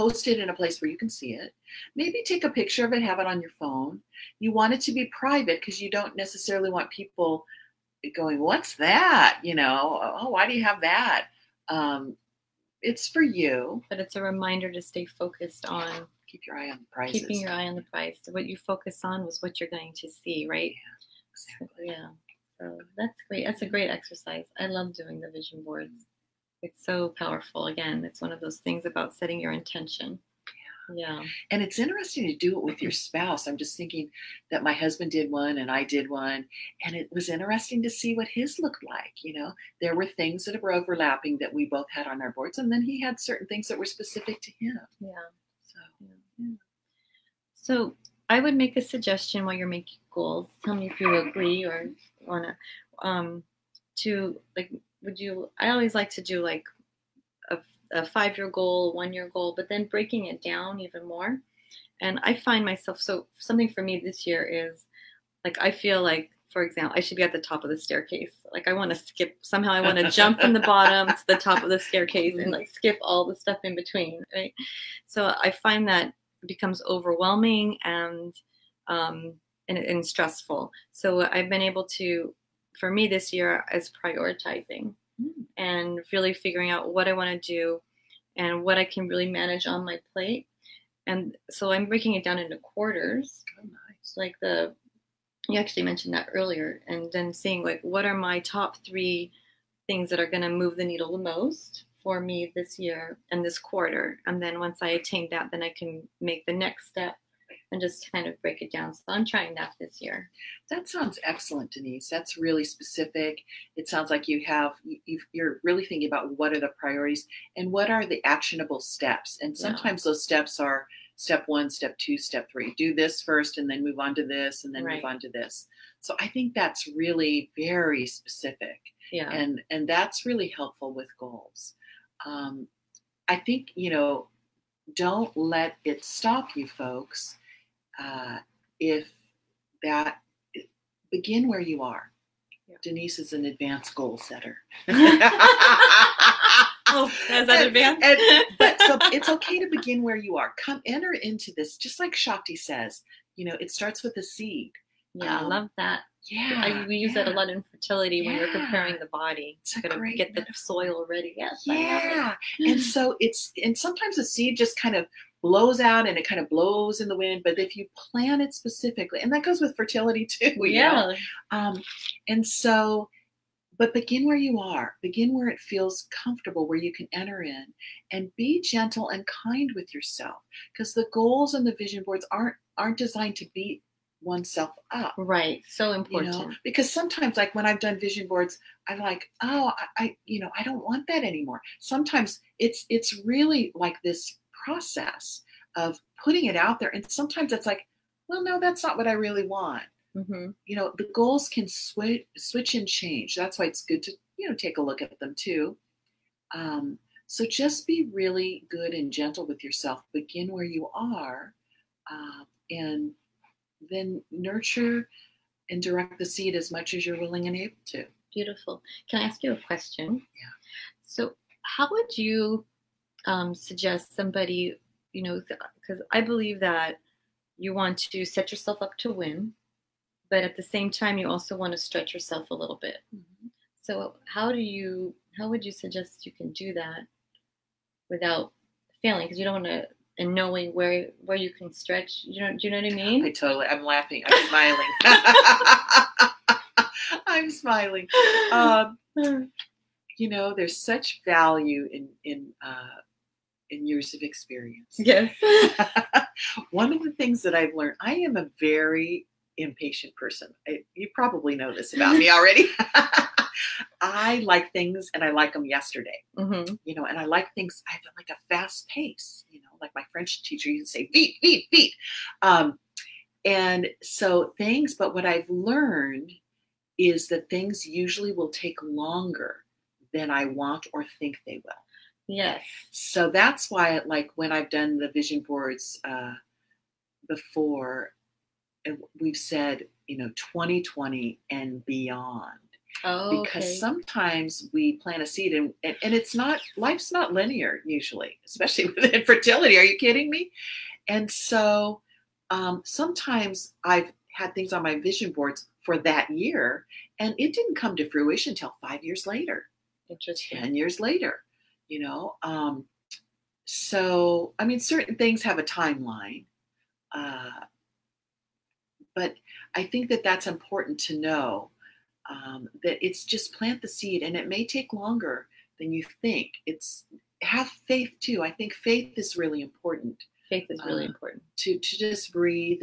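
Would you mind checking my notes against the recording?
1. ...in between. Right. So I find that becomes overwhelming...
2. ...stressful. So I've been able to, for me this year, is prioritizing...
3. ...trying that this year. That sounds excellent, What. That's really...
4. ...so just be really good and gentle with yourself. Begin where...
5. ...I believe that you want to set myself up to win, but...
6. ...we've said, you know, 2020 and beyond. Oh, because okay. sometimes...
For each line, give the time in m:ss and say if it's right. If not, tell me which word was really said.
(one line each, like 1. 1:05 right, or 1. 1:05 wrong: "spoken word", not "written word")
1. 1:13 right
2. 1:20 right
3. 1:49 wrong: "Denise", not "What"
4. 3:27 right
5. 3:46 wrong: "yourself", not "myself"
6. 4:49 right.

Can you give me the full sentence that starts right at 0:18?
What you focus on was what you're going to see, right?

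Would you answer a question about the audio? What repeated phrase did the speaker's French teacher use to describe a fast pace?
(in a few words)
beat, beat, beat.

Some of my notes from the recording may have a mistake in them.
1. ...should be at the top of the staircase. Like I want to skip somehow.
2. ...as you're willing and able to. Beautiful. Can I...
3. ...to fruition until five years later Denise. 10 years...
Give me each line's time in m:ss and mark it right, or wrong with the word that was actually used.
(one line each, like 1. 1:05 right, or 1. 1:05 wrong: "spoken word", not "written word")
1. 1:07 right
2. 3:36 right
3. 5:07 wrong: "Interesting", not "Denise".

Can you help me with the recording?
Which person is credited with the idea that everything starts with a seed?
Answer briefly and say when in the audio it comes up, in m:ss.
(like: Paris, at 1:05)
Shakti, at 2:32.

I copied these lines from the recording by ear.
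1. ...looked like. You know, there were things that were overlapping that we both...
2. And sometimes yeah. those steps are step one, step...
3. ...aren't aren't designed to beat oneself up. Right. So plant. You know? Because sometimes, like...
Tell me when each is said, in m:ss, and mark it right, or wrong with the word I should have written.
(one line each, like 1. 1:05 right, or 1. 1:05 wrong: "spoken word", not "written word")
1. 0:38 right
2. 1:59 right
3. 3:02 wrong: "important", not "plant".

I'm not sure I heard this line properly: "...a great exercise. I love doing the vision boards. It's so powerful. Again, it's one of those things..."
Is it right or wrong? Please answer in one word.
right.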